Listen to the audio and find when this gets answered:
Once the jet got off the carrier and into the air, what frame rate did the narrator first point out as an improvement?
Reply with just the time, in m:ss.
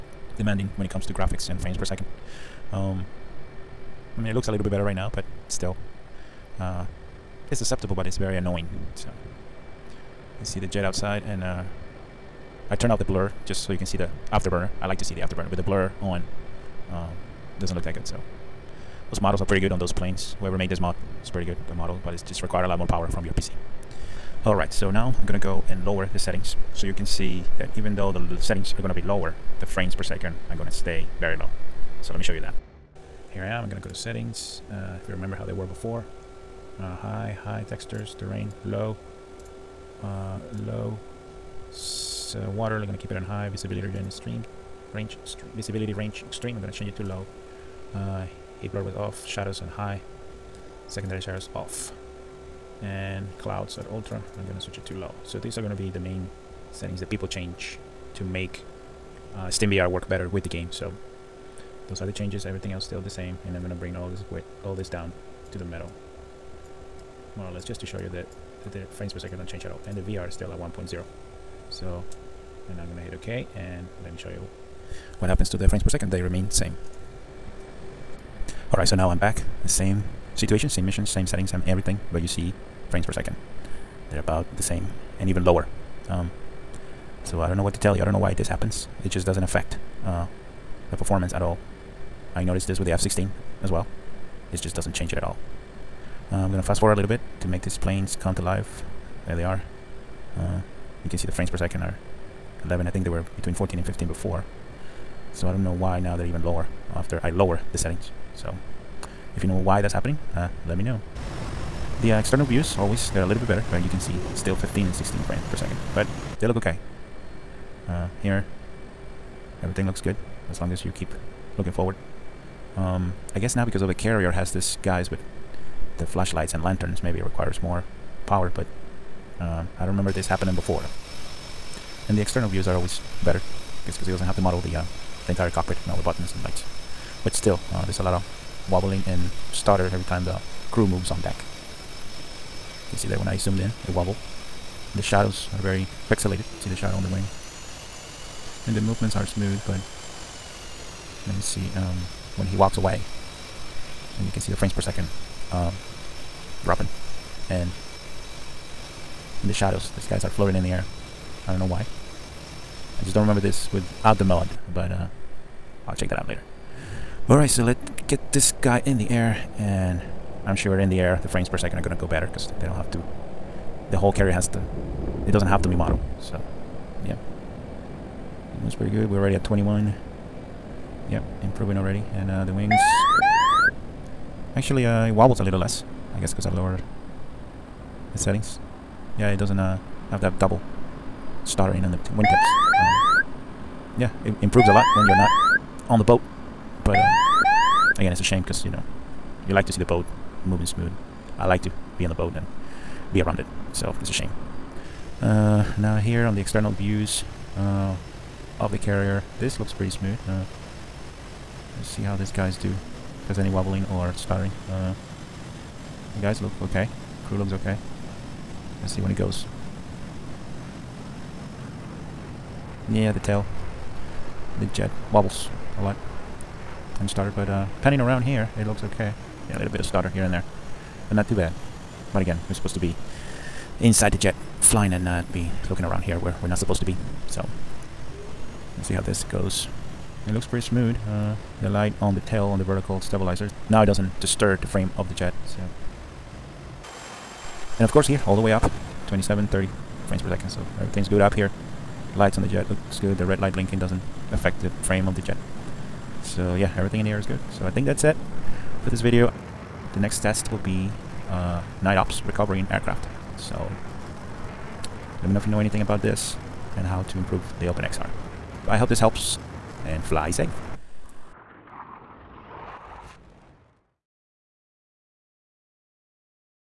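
2:59.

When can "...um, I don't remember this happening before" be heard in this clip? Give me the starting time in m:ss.
2:09.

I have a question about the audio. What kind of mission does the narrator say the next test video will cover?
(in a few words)
night ops recovering aircraft.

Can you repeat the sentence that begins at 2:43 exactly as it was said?
I just don't remember this without the mod, but uh, I'll check that out later.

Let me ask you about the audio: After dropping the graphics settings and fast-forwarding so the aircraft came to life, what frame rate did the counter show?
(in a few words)
11.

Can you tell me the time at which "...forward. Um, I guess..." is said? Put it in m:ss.
2:01.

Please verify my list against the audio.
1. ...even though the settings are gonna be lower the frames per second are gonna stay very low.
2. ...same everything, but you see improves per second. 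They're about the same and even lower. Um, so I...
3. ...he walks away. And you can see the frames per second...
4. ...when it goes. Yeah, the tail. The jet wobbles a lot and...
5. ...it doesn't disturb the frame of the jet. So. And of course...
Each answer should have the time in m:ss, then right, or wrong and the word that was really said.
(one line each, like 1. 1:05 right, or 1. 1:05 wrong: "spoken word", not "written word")
1. 0:27 right
2. 1:21 wrong: "frames", not "improves"
3. 2:32 right
4. 3:38 right
5. 4:03 right.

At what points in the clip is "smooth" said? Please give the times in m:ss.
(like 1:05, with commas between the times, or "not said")
2:29, 3:20, 3:29, 4:00.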